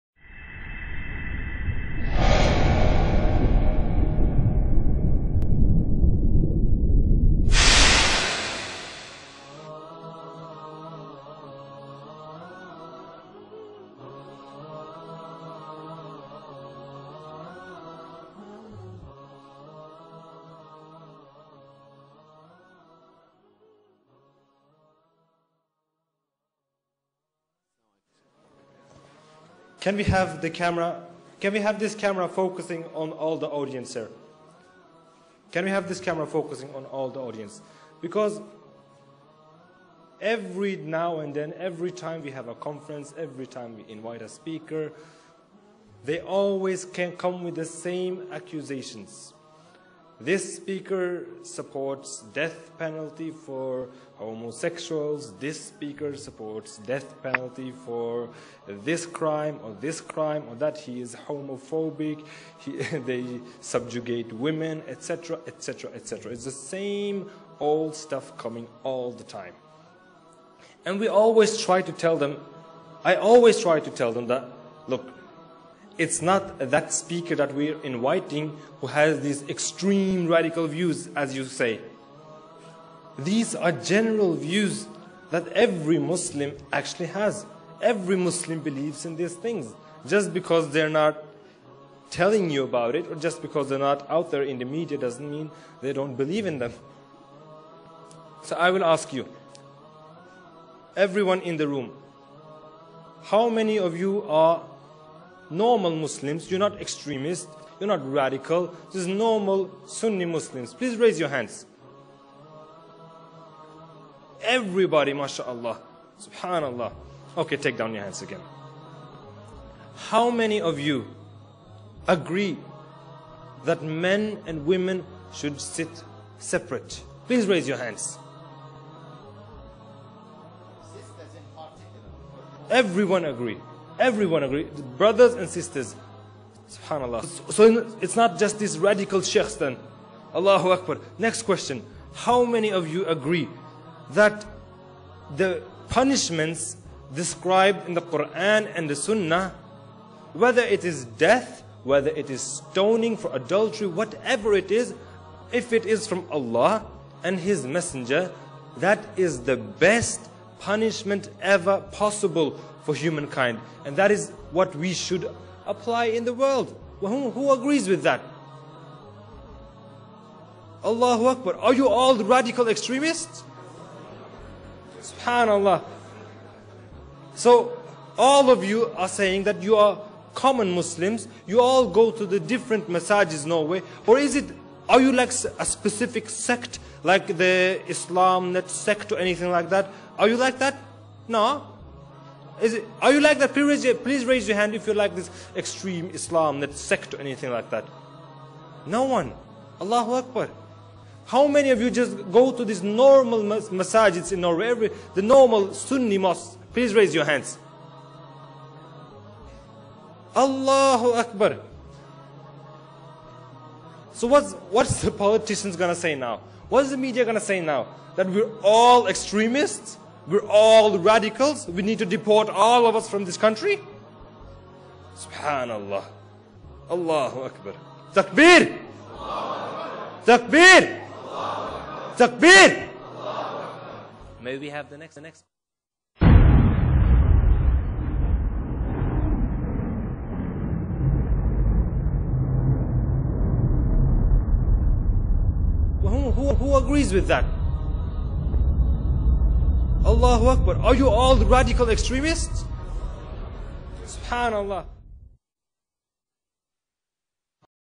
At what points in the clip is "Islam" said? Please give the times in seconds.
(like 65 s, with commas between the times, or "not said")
187 s, 196 s.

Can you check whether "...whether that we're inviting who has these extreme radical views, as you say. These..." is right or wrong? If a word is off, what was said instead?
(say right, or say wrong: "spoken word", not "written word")
wrong: "speaker", not "whether".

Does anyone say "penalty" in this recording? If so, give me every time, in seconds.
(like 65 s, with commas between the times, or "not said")
52 s, 57 s.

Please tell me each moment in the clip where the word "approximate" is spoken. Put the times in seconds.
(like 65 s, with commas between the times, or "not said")
not said.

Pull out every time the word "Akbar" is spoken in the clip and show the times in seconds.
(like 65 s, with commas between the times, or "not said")
140 s, 171 s, 200 s, 211 s, 227 s, 250 s.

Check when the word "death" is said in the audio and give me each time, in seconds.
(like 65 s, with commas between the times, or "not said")
52 s, 56 s, 151 s.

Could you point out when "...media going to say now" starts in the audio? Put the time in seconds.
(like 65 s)
216 s.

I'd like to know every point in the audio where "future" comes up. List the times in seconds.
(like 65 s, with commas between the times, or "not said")
not said.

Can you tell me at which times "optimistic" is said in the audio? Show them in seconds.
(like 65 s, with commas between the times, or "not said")
not said.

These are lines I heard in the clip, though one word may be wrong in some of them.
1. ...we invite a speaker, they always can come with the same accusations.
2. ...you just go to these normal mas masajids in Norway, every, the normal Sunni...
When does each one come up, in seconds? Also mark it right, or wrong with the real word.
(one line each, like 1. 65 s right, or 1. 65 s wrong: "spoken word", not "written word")
1. 43 s right
2. 201 s right.